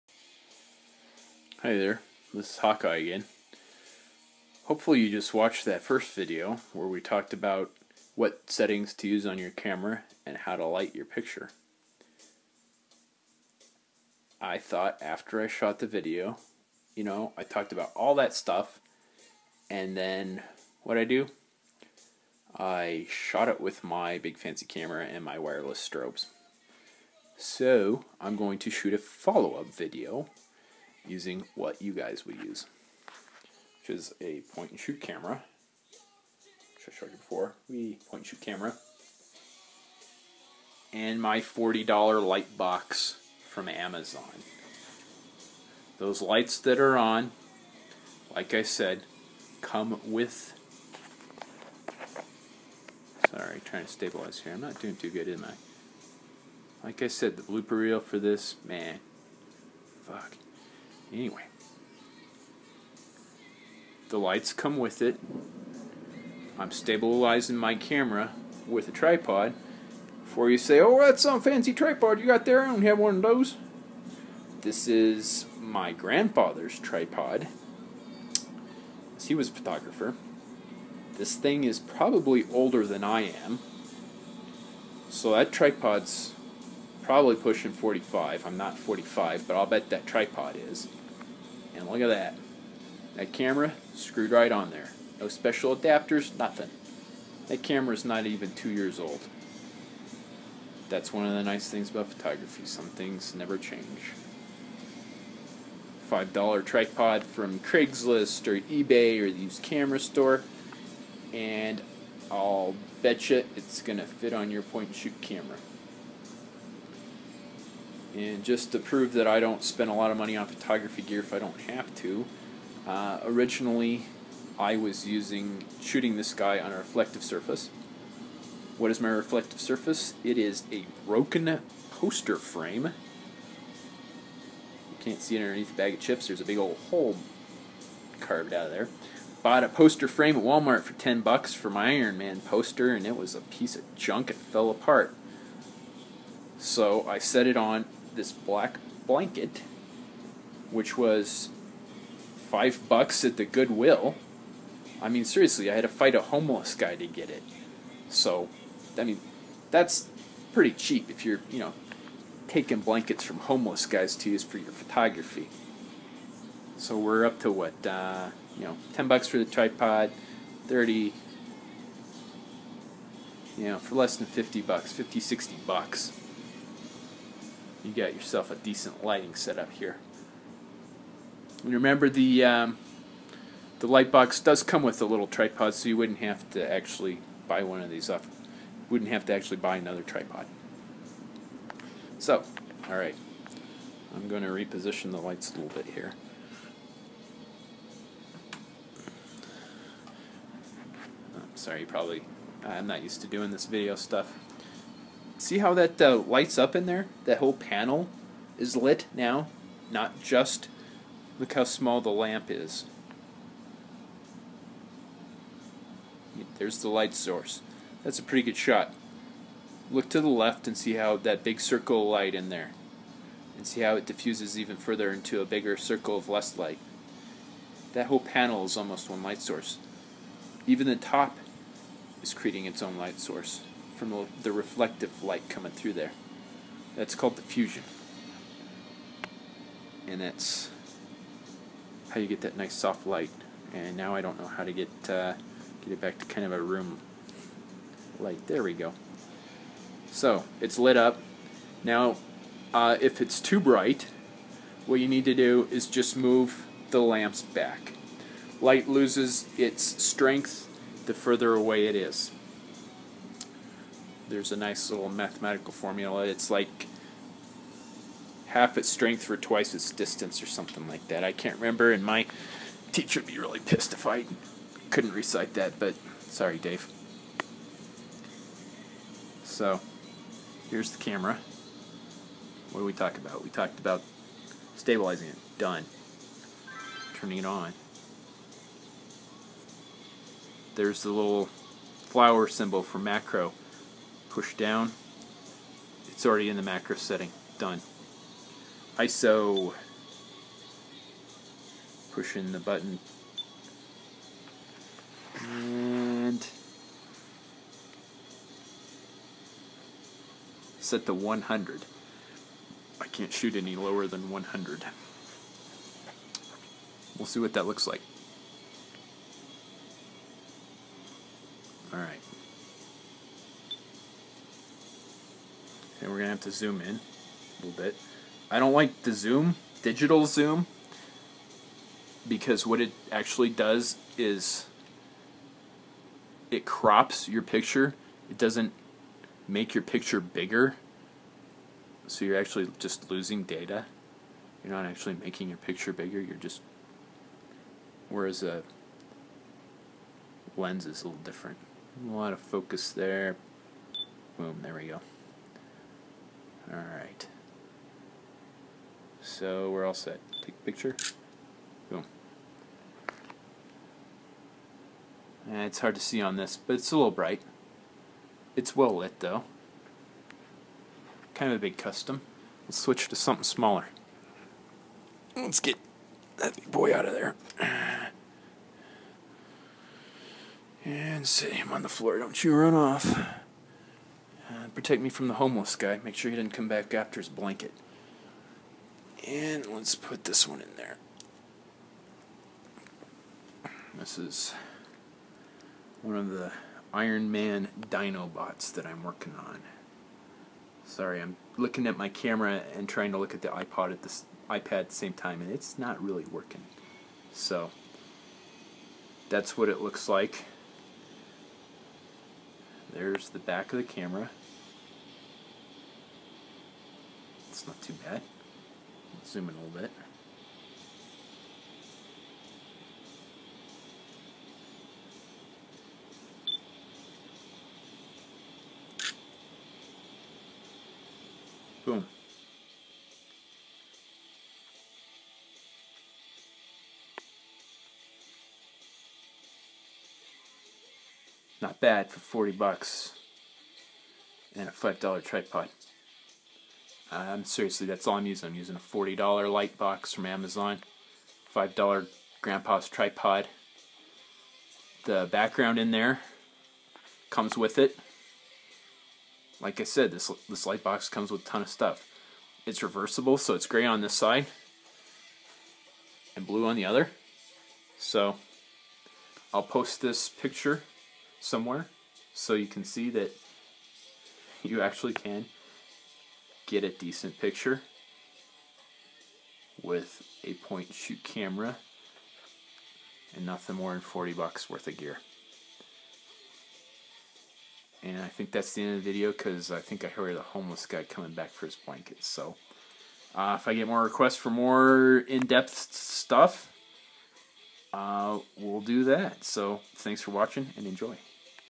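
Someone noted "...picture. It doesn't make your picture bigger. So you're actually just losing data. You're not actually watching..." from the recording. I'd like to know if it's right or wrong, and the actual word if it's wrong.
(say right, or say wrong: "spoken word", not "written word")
wrong: "making", not "watching".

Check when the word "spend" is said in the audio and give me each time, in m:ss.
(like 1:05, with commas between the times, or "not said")
1:59.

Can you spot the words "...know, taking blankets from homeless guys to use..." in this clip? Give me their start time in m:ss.
2:41.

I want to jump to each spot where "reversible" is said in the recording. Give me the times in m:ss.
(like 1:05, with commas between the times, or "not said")
7:42.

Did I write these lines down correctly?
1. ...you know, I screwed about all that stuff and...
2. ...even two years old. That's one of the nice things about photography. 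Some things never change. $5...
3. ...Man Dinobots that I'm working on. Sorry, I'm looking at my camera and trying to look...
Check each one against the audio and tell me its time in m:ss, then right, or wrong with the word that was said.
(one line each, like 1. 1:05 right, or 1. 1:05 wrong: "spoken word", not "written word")
1. 0:16 wrong: "talked", not "screwed"
2. 1:38 right
3. 6:37 right.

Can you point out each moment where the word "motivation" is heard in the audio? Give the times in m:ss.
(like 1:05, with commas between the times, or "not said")
not said.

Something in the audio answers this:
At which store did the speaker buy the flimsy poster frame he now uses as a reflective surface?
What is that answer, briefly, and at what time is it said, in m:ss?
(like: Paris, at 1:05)
Walmart, at 2:20.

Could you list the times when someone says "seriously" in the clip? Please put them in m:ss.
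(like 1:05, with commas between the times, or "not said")
2:35, 7:27.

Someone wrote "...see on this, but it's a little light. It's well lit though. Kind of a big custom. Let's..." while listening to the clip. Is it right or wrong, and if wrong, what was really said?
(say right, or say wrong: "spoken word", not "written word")
wrong: "bright", not "light".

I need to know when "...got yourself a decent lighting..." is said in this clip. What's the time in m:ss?
2:57.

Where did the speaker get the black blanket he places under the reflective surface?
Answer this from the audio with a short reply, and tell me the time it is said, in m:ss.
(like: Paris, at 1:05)
Goodwill, at 2:33.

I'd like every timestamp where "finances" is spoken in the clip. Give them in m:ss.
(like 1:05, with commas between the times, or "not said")
not said.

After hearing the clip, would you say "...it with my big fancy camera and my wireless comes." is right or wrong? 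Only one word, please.
wrong.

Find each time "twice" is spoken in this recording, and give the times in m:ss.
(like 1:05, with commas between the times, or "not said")
4:29.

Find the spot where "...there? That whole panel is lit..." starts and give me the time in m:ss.
3:26.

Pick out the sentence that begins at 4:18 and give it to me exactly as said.
Light loses its strength the further away it is there's a nice little mathematical formula.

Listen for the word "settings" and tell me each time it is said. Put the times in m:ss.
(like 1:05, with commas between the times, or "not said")
0:08, 4:56.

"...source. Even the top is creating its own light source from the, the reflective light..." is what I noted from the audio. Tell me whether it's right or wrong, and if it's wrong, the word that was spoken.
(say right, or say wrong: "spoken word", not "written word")
right.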